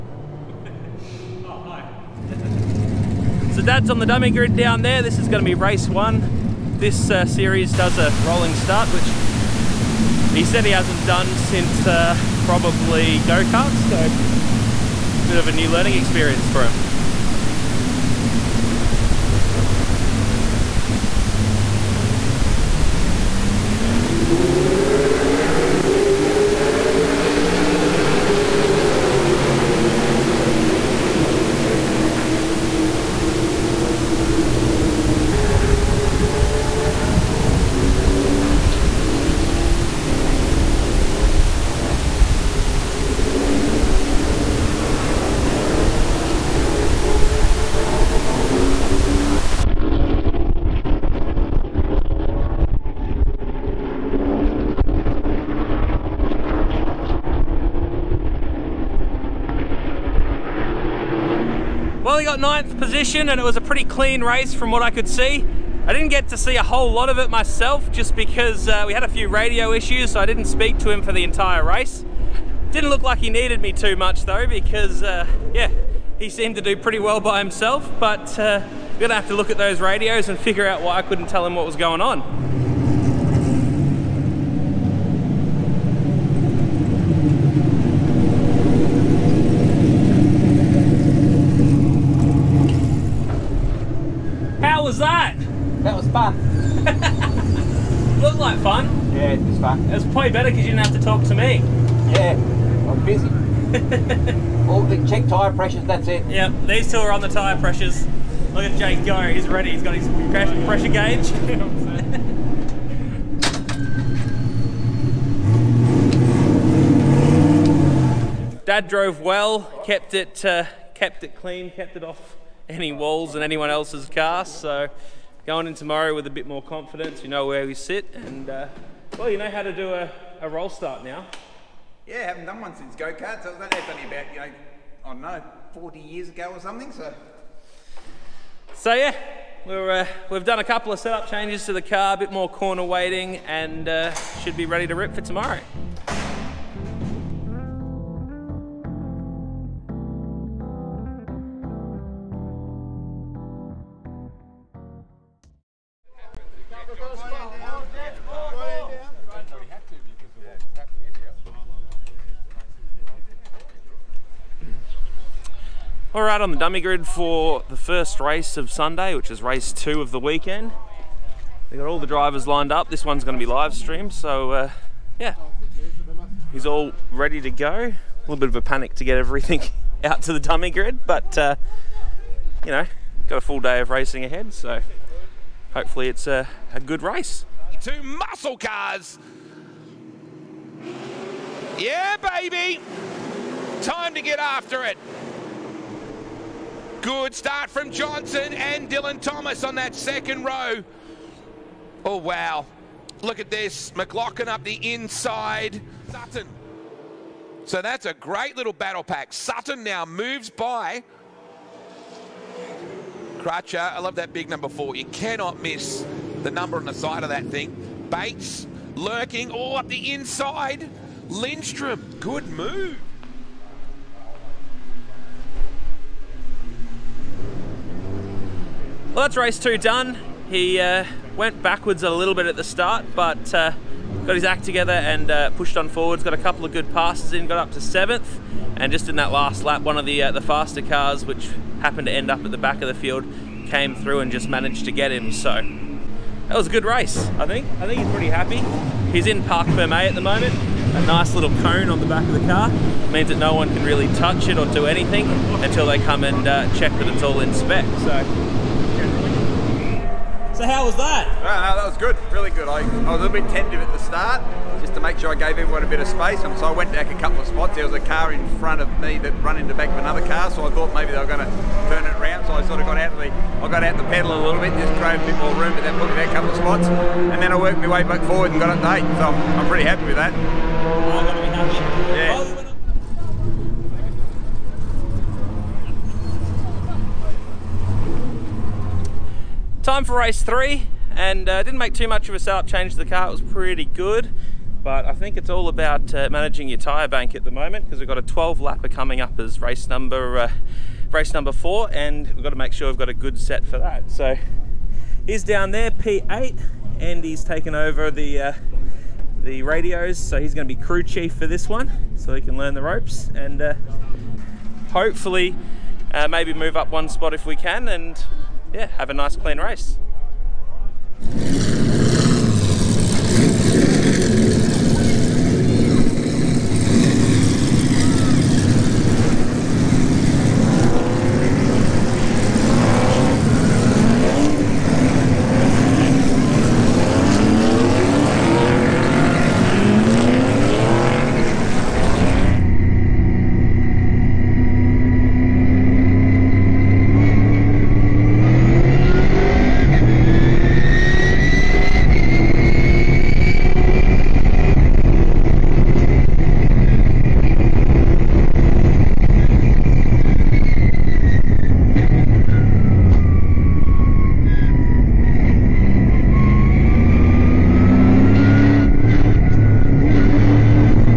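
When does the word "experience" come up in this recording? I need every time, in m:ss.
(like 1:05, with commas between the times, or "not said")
0:15.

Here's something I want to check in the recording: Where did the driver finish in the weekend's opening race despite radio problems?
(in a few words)
9th.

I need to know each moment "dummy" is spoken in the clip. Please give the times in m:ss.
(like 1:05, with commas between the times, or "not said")
0:04, 2:46, 3:00.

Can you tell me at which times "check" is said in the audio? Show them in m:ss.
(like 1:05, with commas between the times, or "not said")
1:45, 4:16.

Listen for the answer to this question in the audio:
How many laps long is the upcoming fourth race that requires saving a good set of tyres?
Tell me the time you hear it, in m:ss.
4:58.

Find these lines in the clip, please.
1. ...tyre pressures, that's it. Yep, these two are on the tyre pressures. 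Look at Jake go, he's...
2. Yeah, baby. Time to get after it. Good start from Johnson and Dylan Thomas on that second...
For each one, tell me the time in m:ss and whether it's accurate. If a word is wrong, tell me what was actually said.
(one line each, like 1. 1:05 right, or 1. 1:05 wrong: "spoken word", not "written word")
1. 1:45 right
2. 3:11 right.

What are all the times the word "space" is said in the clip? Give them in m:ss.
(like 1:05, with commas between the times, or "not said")
4:26.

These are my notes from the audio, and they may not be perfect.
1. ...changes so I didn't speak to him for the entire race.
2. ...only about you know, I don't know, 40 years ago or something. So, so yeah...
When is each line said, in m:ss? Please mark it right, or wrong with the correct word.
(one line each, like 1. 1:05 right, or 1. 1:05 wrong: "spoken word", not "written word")
1. 1:09 wrong: "issues", not "changes"
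2. 2:13 right.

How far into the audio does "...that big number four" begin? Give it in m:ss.
3:34.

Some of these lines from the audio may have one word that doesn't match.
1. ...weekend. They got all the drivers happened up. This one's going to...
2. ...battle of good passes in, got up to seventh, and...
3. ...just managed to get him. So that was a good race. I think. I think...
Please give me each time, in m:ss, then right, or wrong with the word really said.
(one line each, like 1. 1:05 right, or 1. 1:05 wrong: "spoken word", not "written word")
1. 2:50 wrong: "lined", not "happened"
2. 3:56 wrong: "couple", not "battle"
3. 4:04 right.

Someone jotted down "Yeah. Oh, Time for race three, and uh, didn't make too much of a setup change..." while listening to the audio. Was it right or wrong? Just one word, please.
right.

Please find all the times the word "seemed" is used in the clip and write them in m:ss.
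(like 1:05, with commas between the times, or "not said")
1:16.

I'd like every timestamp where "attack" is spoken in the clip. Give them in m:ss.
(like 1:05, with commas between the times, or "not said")
not said.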